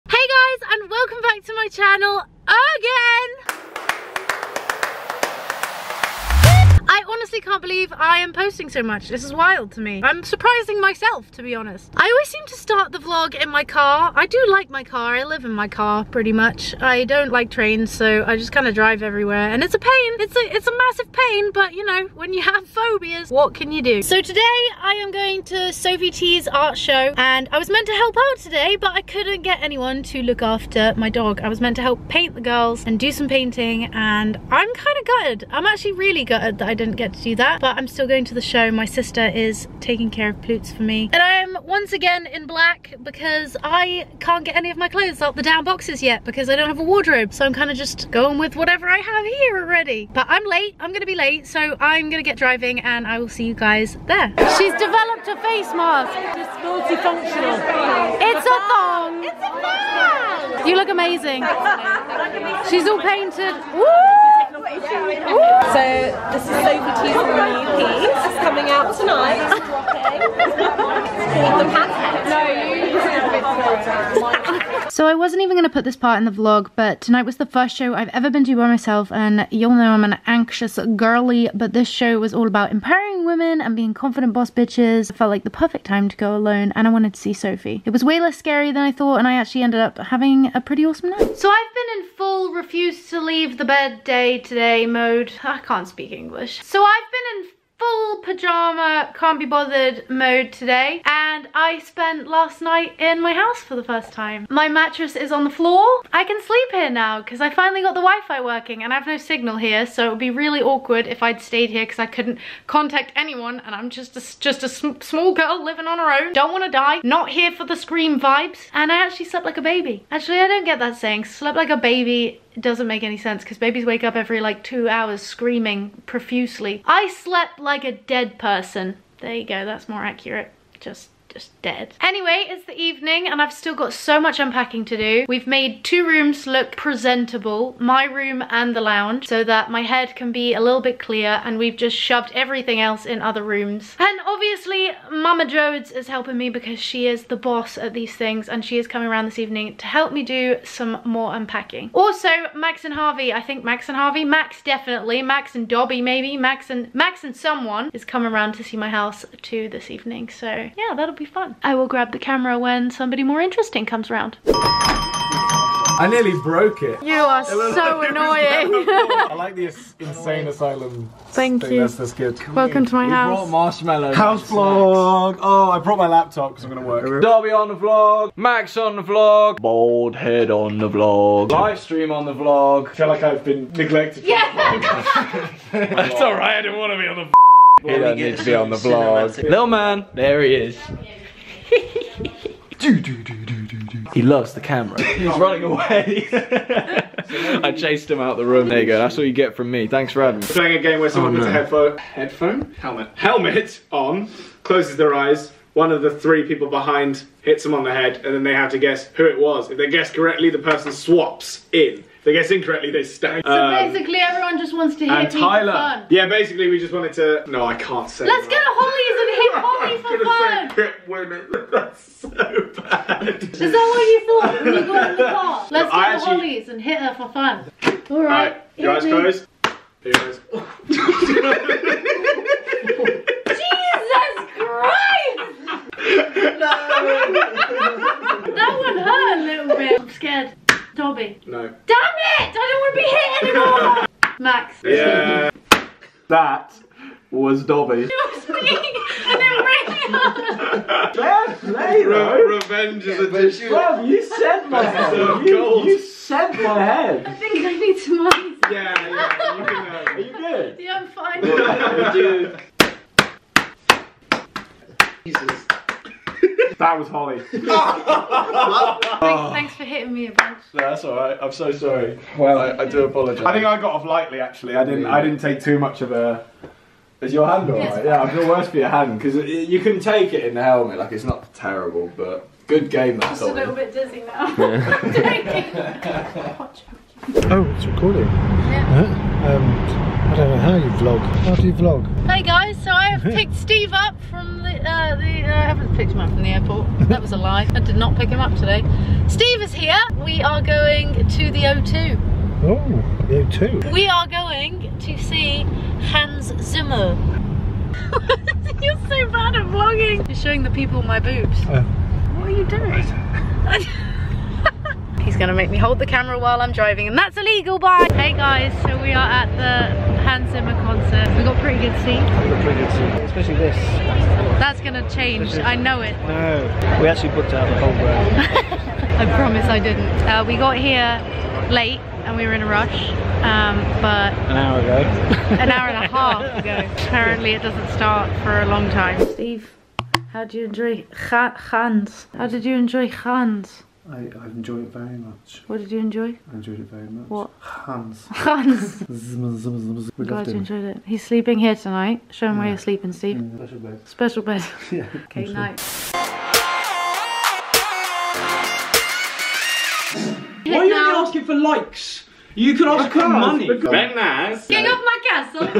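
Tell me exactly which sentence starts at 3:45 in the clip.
Let's no, go I to actually...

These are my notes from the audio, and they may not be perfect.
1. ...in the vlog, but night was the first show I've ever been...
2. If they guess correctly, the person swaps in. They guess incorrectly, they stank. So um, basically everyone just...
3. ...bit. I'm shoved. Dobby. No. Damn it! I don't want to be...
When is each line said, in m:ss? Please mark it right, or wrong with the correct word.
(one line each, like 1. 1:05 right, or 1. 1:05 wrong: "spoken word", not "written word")
1. 1:16 wrong: "tonight", not "night"
2. 3:29 right
3. 3:59 wrong: "scared", not "shoved".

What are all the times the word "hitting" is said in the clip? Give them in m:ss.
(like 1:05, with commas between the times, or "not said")
4:29.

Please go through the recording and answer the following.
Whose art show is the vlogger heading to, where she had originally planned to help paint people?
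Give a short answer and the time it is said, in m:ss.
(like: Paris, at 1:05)
Sophie Tea, at 0:25.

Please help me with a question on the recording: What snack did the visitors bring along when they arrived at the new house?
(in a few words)
Marshmallows.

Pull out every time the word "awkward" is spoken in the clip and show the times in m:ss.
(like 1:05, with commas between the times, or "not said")
1:50.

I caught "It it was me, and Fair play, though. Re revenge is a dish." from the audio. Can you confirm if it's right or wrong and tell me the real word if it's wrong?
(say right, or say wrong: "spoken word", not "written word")
right.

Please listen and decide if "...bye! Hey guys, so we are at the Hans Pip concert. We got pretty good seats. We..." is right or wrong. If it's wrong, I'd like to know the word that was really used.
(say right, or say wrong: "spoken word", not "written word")
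wrong: "Zimmer", not "Pip".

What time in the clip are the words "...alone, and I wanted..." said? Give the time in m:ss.
1:26.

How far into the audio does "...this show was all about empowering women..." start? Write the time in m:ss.
1:21.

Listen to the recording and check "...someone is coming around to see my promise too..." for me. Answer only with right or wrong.
wrong.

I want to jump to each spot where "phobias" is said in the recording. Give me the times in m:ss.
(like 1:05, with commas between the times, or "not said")
0:22.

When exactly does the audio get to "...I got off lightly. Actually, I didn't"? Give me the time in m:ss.
4:33.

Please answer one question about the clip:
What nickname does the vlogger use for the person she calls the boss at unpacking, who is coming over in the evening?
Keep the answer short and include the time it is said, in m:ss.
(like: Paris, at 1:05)
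Mama Jodes, at 2:25.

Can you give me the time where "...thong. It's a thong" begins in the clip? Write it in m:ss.
0:58.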